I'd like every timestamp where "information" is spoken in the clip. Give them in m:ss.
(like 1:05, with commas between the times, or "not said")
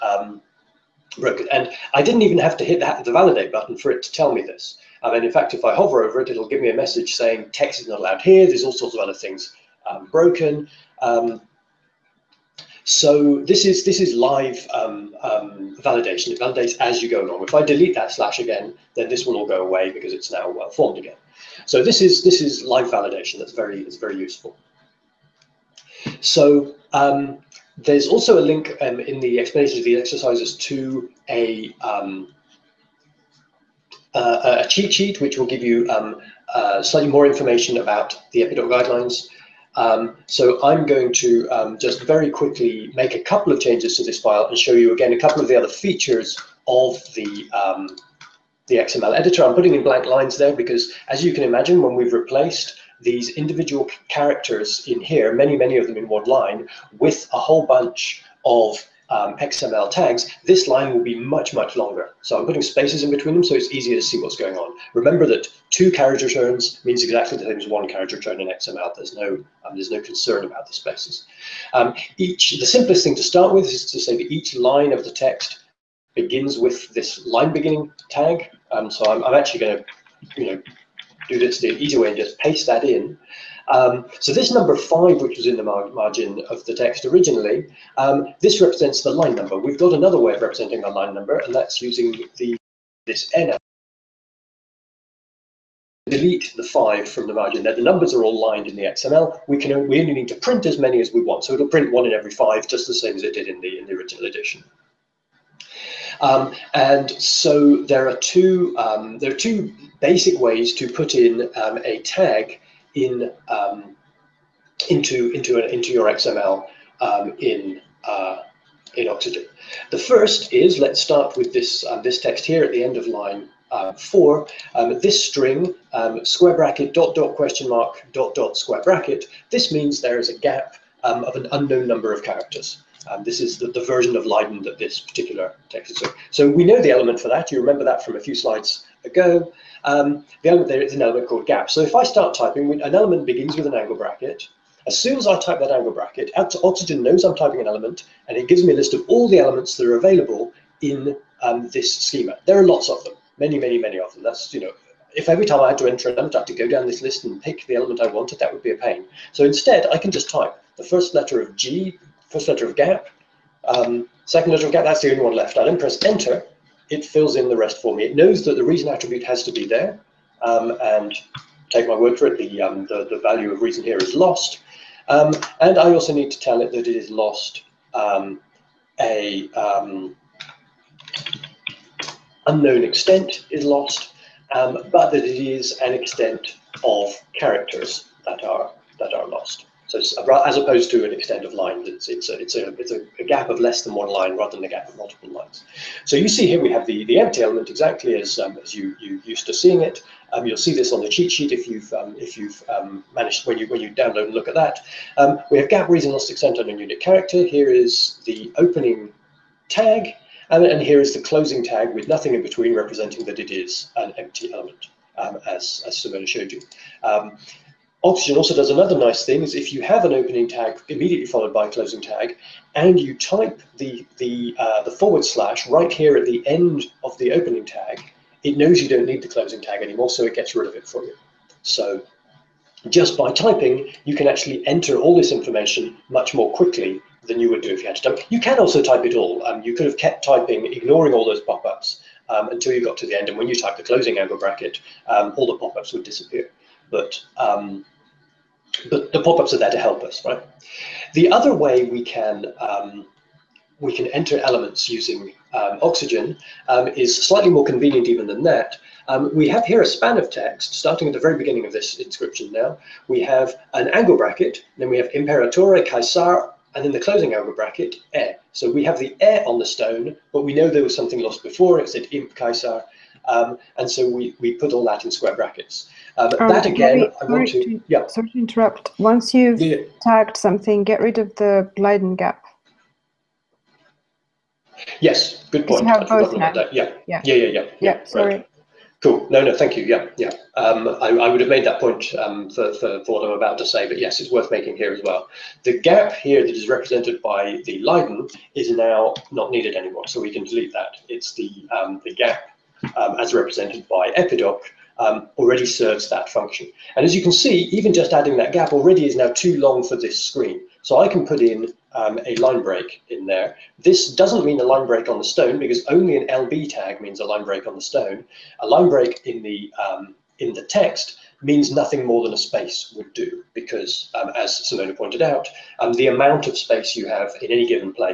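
0:37, 3:55.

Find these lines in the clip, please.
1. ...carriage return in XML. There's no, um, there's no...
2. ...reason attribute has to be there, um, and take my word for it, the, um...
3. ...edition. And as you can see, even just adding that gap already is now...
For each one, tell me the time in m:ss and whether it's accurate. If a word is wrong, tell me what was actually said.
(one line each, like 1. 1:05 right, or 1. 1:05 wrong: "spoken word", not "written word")
1. 1:07 right
2. 2:48 right
3. 5:06 wrong: "function", not "edition".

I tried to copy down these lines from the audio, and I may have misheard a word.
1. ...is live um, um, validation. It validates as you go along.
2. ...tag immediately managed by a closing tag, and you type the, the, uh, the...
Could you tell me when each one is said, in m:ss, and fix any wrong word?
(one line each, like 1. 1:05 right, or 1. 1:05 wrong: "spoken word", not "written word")
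1. 0:14 right
2. 3:40 wrong: "followed", not "managed".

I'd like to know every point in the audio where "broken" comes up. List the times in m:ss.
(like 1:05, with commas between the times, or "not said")
0:01, 0:10.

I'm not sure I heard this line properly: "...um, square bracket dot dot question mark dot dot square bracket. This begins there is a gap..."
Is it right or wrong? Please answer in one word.
wrong.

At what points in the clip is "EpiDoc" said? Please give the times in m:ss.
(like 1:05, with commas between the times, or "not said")
0:38, 5:04.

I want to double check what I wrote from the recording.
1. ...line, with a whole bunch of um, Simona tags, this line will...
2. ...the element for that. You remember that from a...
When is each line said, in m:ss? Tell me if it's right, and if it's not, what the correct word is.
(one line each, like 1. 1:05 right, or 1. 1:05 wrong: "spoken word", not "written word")
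1. 0:56 wrong: "XML", not "Simona"
2. 2:16 right.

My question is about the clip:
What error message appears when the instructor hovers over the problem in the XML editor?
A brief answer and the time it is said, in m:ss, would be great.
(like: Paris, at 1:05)
Text is not allowed here, at 0:07.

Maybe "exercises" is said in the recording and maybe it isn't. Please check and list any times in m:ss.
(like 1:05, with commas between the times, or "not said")
0:29.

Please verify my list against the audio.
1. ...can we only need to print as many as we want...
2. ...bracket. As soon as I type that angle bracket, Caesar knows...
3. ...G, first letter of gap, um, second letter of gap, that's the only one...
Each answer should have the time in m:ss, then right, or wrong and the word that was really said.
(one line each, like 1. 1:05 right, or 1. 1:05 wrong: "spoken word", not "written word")
1. 1:39 right
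2. 2:23 wrong: "Oxygen", not "Caesar"
3. 2:41 right.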